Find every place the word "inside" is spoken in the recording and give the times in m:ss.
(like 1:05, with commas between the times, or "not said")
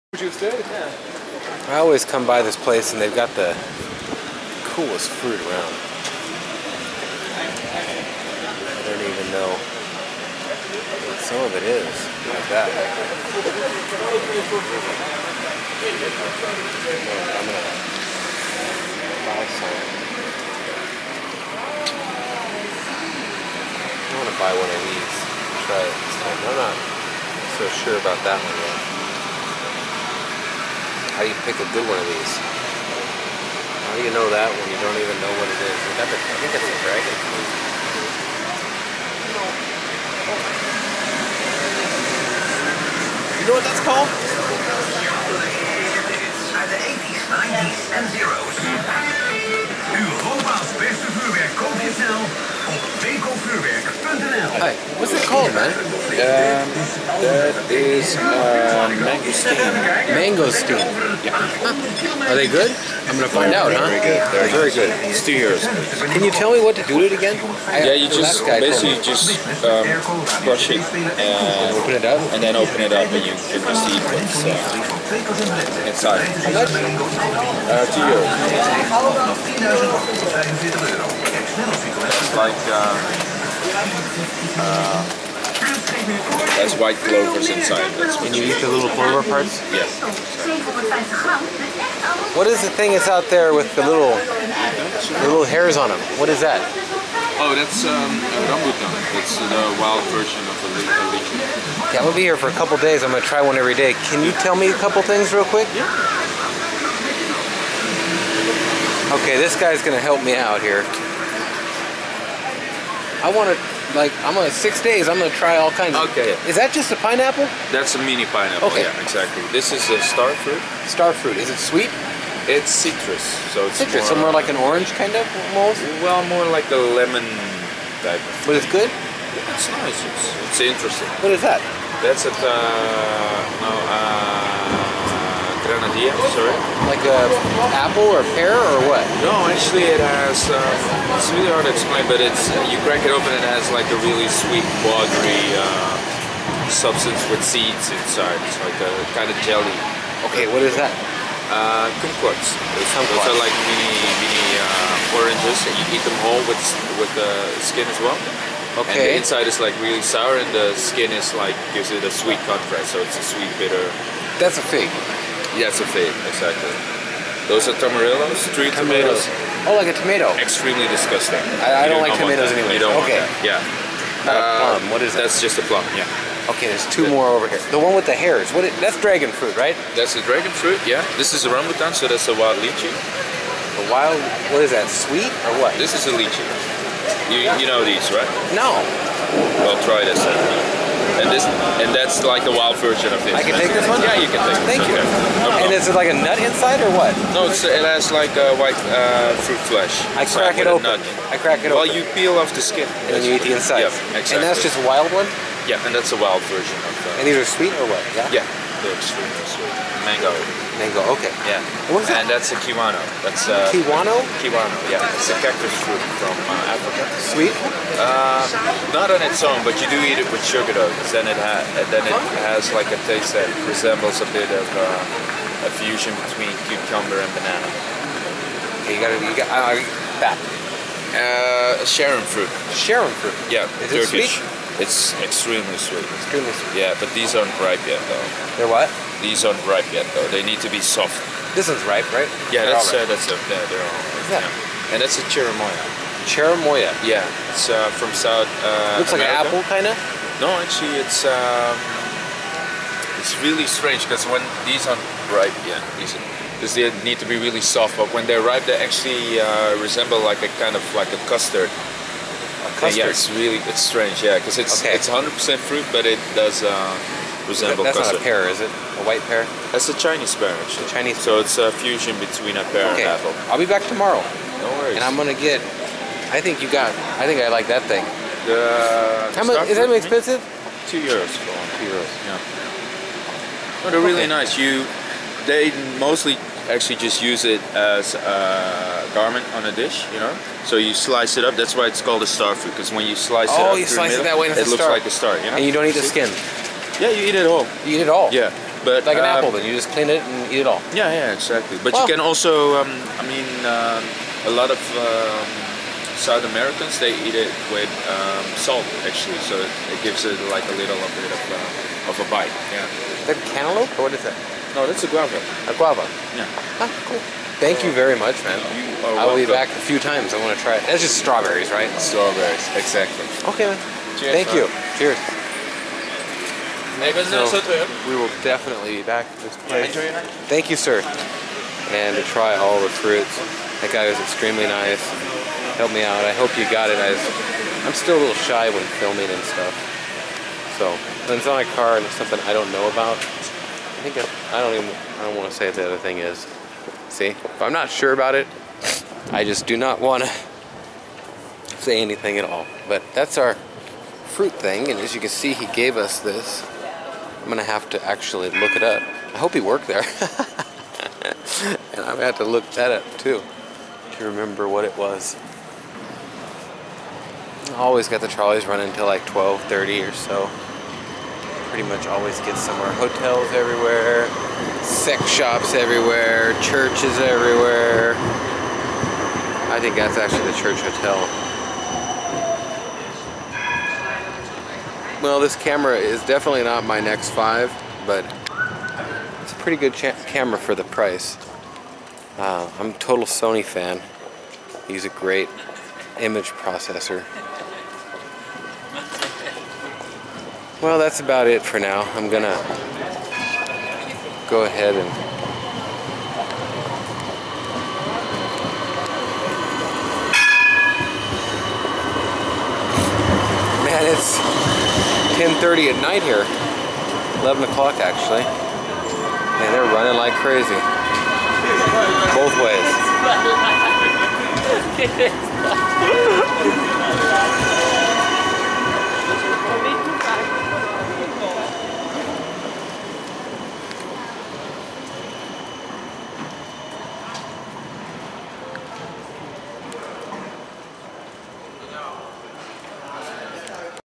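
1:15, 1:27, 2:27, 2:39, 3:16, 3:23.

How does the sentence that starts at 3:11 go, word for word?
And this and that's like a wild version of this.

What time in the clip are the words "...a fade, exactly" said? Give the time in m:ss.
2:45.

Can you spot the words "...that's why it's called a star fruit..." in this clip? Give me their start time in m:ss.
4:51.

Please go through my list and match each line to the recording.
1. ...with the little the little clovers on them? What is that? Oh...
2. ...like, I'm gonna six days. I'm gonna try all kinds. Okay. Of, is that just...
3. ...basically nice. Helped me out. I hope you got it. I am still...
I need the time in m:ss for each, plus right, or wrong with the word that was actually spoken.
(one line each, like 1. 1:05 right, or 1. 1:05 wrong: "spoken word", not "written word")
1. 1:33 wrong: "hairs", not "clovers"
2. 1:53 right
3. 5:34 wrong: "extremely", not "basically".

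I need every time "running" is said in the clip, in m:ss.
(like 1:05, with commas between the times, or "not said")
6:08, 6:59.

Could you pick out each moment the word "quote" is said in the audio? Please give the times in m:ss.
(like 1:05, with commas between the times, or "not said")
not said.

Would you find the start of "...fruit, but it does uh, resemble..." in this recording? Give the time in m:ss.
4:25.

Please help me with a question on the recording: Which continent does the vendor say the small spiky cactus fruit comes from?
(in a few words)
Africa.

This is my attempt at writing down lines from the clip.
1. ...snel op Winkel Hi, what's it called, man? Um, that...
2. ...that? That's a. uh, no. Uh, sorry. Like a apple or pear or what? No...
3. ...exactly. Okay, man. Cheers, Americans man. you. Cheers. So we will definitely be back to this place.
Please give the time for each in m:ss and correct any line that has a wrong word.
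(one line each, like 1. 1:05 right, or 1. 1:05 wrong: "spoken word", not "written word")
1. 0:52 right
2. 2:11 right
3. 5:22 wrong: "Thank", not "Americans".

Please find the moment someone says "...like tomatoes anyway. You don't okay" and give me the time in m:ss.
2:52.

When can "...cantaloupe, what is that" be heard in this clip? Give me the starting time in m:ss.
5:13.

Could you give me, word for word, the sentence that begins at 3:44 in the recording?
Uh, a fusion between cucumber and banana.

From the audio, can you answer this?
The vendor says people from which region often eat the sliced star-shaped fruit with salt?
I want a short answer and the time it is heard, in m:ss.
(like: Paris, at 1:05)
South Americans, at 5:06.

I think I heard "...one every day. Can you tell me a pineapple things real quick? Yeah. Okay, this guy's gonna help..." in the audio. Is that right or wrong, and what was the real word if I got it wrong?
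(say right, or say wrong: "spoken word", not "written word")
wrong: "couple", not "pineapple".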